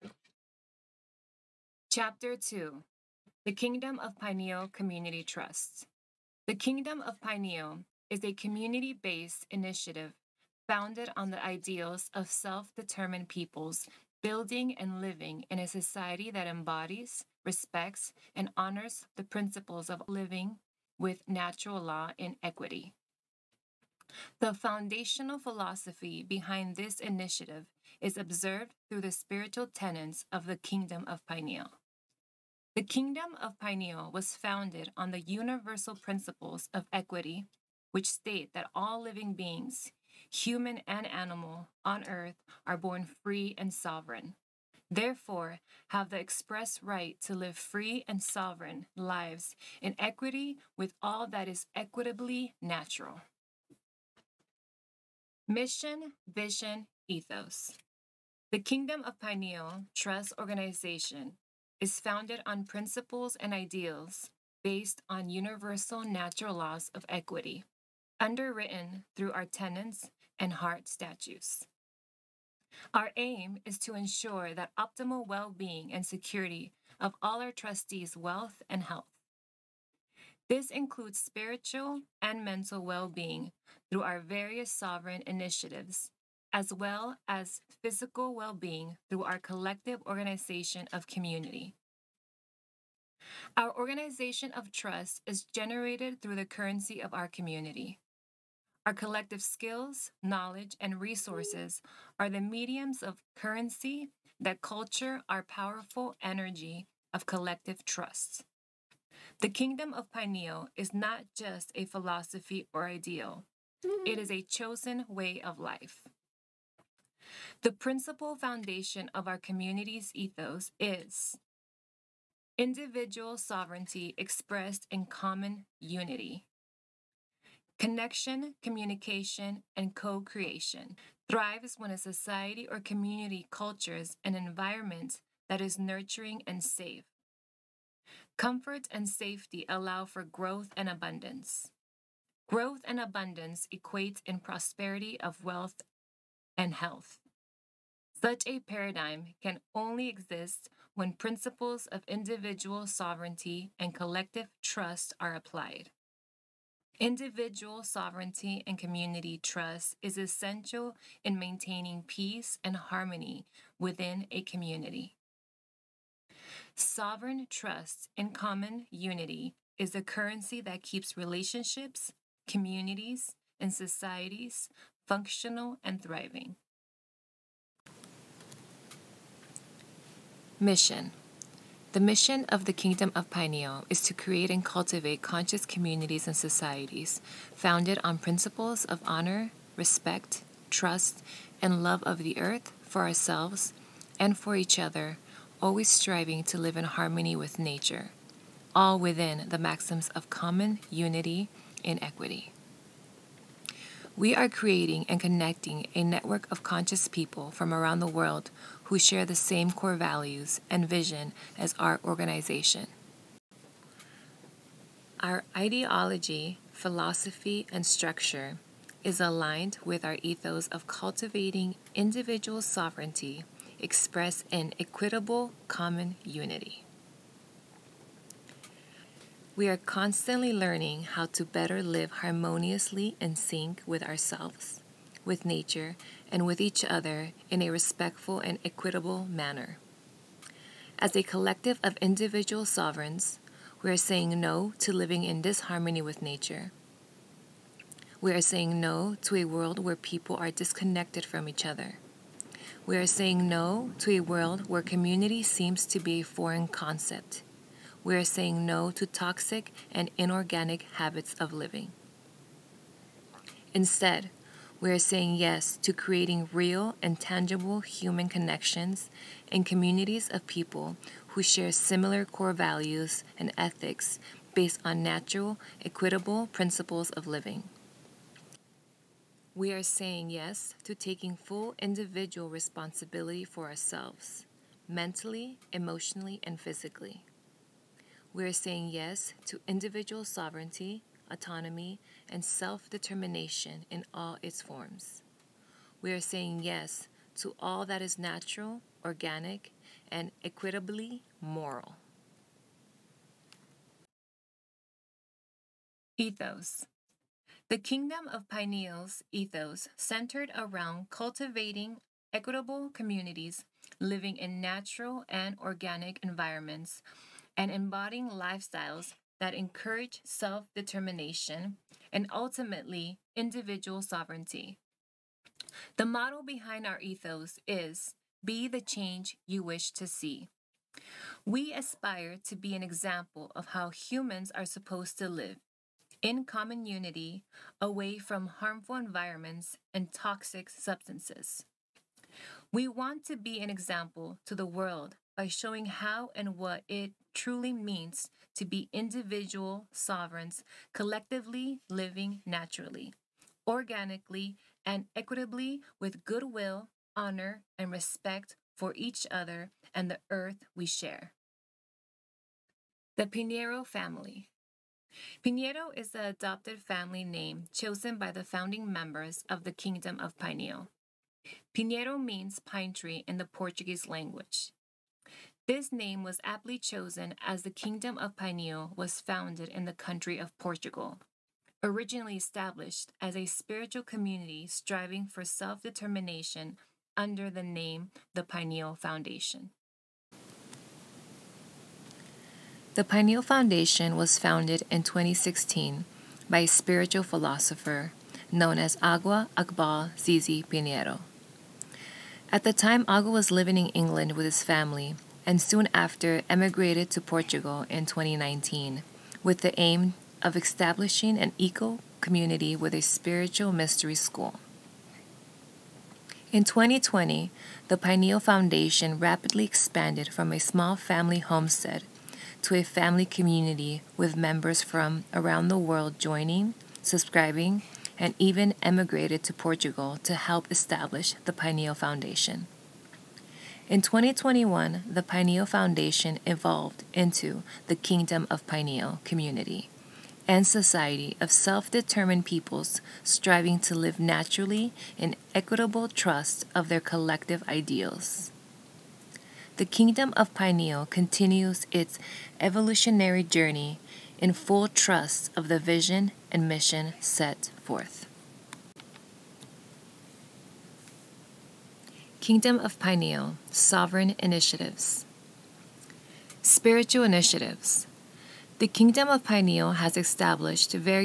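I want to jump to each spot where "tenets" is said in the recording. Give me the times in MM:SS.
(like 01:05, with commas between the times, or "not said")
00:29, 01:09.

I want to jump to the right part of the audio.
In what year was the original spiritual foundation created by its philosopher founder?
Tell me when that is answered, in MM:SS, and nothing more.
06:35.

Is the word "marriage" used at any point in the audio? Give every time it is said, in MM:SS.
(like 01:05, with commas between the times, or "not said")
not said.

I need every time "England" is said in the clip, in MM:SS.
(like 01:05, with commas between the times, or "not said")
06:43.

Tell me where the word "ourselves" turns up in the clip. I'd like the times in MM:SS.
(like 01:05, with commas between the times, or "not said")
03:13, 03:54, 04:43.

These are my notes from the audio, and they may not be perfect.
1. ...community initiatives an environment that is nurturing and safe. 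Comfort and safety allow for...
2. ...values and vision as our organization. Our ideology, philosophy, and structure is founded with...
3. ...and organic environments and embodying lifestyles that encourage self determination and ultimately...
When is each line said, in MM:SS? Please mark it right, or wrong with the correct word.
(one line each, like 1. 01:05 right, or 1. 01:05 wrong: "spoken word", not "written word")
1. 02:12 wrong: "cultures", not "initiatives"
2. 03:29 wrong: "aligned", not "founded"
3. 05:15 right.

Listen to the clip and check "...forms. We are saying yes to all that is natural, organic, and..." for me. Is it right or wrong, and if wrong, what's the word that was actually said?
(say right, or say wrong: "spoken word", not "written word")
right.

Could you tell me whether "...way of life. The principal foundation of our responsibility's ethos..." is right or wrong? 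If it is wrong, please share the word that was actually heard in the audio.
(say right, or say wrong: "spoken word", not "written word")
wrong: "community", not "responsibility".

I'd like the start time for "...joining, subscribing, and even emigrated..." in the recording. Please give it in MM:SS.
07:06.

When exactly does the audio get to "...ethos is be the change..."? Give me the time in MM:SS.
05:26.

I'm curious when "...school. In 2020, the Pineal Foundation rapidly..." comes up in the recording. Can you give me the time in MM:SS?
06:54.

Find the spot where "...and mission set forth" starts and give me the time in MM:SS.
07:36.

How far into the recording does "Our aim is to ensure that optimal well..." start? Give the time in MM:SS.
01:12.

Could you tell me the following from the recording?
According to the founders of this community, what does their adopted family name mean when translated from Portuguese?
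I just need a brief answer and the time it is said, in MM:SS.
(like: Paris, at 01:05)
Pine tree, at 06:12.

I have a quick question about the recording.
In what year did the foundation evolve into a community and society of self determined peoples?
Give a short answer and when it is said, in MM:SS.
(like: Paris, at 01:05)
2021, at 07:13.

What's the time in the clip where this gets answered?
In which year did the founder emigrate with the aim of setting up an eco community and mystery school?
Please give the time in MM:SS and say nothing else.
06:48.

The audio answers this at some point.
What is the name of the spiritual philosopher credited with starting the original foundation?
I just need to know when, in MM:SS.
06:38.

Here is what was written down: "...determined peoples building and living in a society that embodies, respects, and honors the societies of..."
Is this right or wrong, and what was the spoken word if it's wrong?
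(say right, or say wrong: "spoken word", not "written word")
wrong: "principles", not "societies".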